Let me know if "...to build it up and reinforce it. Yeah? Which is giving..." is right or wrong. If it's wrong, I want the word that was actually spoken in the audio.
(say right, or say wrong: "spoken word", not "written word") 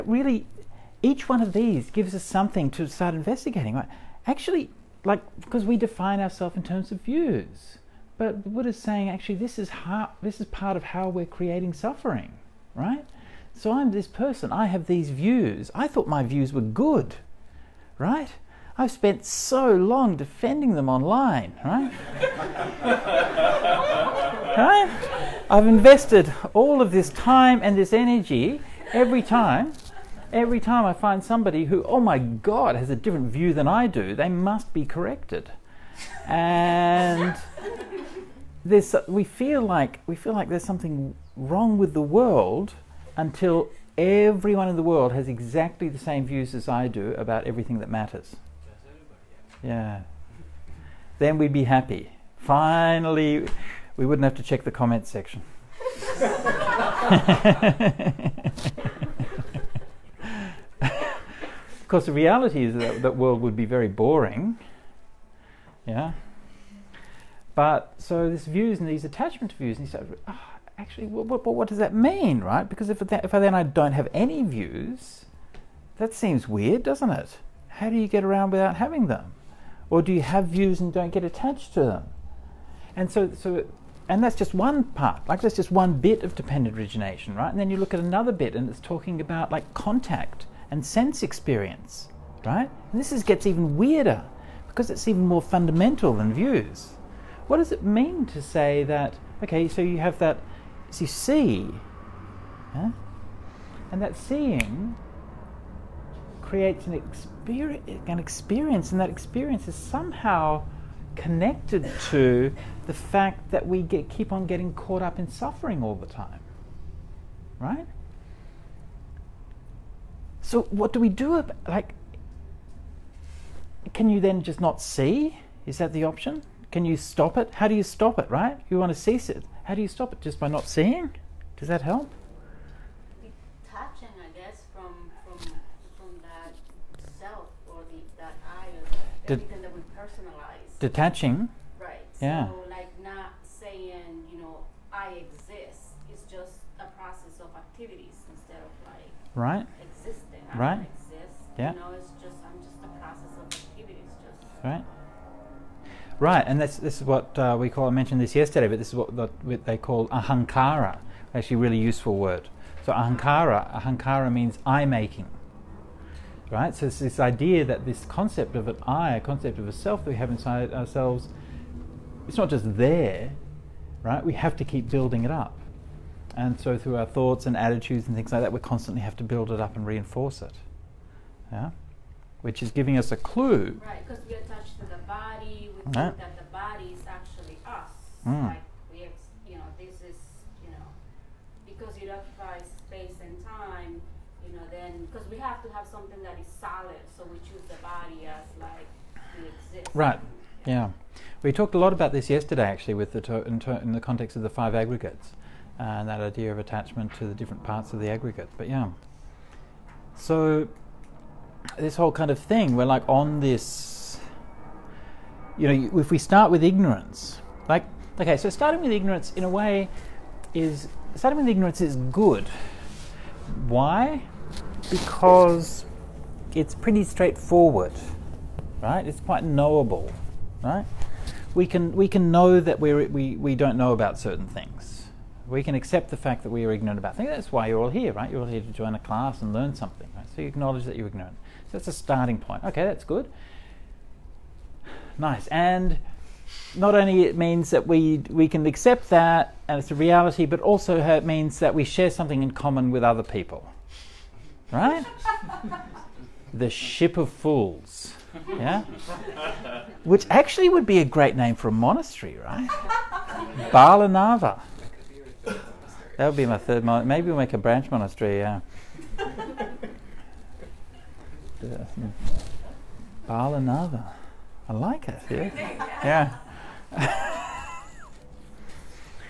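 right.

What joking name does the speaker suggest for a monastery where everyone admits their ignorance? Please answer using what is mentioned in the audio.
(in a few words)
the ship of fools.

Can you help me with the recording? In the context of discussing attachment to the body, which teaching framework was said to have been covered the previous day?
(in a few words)
the five aggregates.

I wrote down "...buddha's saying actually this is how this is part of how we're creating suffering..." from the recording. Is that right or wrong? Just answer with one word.
right.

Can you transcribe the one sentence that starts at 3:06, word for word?
think that the body is actually us.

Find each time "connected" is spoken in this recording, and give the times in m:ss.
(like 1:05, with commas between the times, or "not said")
1:51.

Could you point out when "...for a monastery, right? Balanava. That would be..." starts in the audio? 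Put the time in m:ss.
4:21.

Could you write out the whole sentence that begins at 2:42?
So ahankara, ahankara means I making right?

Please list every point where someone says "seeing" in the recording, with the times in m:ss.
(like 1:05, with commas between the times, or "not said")
1:44, 2:10.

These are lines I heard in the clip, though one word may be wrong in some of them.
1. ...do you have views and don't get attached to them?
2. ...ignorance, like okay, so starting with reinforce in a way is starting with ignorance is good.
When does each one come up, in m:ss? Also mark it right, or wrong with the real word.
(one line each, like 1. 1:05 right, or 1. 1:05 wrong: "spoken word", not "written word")
1. 1:20 right
2. 3:36 wrong: "ignorance", not "reinforce".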